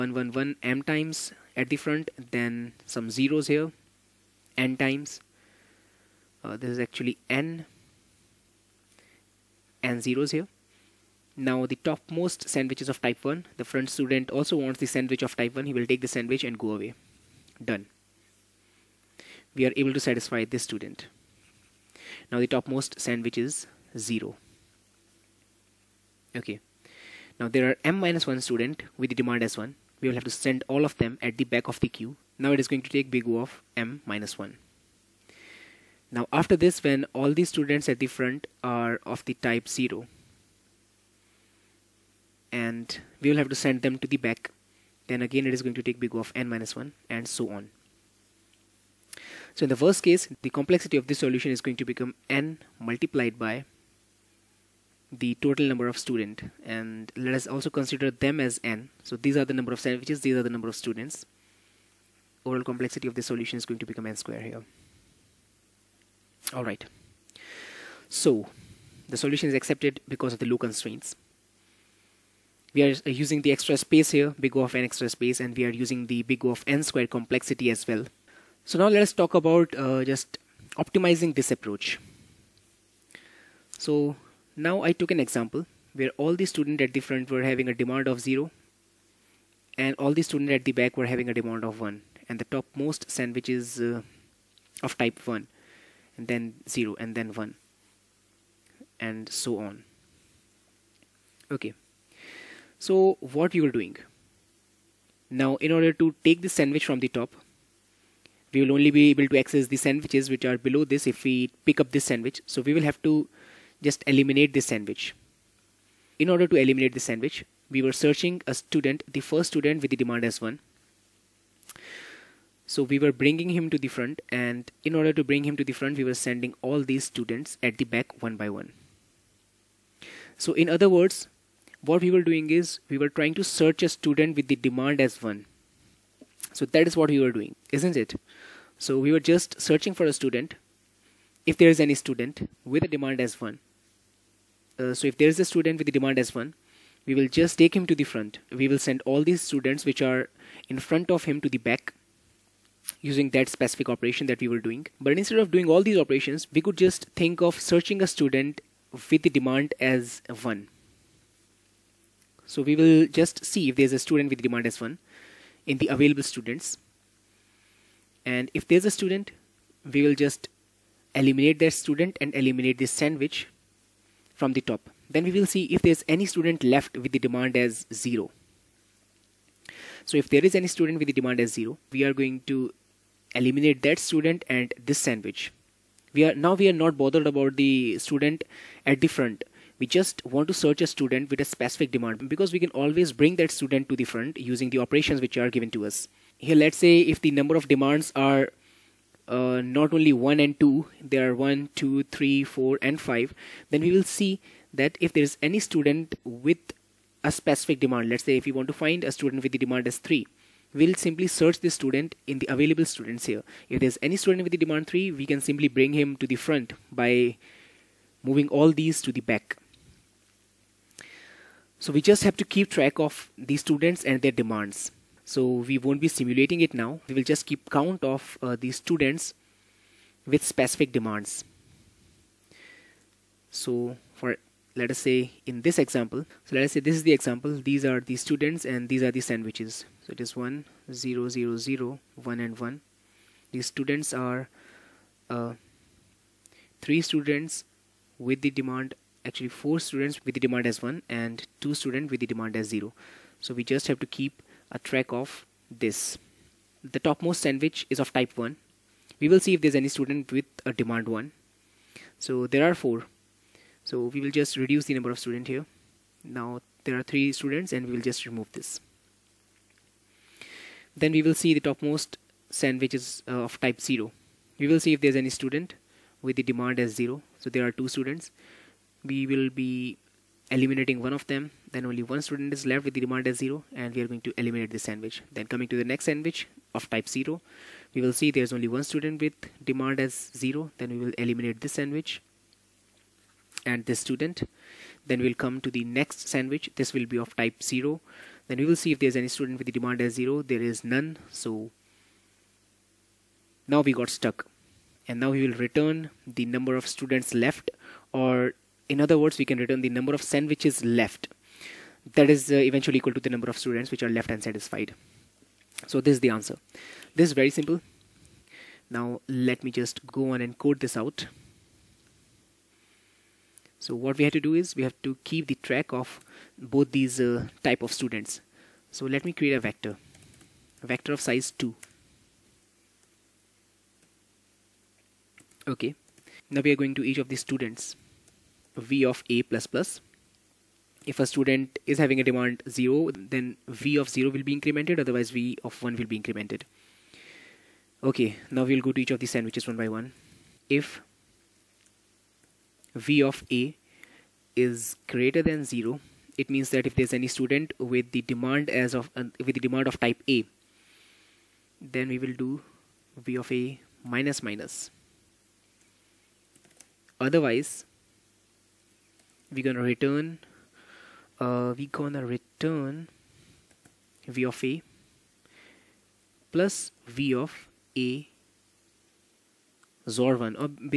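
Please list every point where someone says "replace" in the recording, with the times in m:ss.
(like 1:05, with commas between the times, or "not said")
not said.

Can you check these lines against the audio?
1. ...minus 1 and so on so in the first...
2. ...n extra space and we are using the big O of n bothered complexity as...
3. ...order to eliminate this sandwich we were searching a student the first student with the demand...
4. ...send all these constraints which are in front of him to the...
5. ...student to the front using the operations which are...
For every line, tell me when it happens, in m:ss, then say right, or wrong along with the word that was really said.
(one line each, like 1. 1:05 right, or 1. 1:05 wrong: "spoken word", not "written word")
1. 0:46 right
2. 1:14 wrong: "squared", not "bothered"
3. 1:56 right
4. 2:28 wrong: "students", not "constraints"
5. 3:13 right.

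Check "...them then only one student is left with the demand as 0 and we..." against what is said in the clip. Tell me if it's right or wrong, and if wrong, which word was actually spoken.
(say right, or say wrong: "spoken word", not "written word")
right.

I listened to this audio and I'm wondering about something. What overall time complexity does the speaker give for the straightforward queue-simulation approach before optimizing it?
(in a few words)
n squared.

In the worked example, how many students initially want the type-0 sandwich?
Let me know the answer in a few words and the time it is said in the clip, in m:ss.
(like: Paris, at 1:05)
2, at 4:11.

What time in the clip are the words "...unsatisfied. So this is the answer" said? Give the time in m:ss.
5:14.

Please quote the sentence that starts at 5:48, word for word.
Okay, now we'll go to each of these sandwiches one by one.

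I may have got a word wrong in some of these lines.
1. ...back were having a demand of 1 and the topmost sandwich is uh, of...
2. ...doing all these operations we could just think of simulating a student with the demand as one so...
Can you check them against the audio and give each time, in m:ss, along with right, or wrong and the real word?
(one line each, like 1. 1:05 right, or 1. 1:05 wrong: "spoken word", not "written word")
1. 1:30 right
2. 2:35 wrong: "searching", not "simulating".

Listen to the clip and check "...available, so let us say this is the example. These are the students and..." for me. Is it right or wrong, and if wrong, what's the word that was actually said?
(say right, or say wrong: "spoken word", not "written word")
wrong: "example", not "available".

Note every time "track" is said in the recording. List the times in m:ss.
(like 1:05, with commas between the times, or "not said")
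3:42, 4:14, 5:25.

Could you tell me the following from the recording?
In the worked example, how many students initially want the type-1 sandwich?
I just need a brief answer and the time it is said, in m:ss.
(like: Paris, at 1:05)
4, at 4:09.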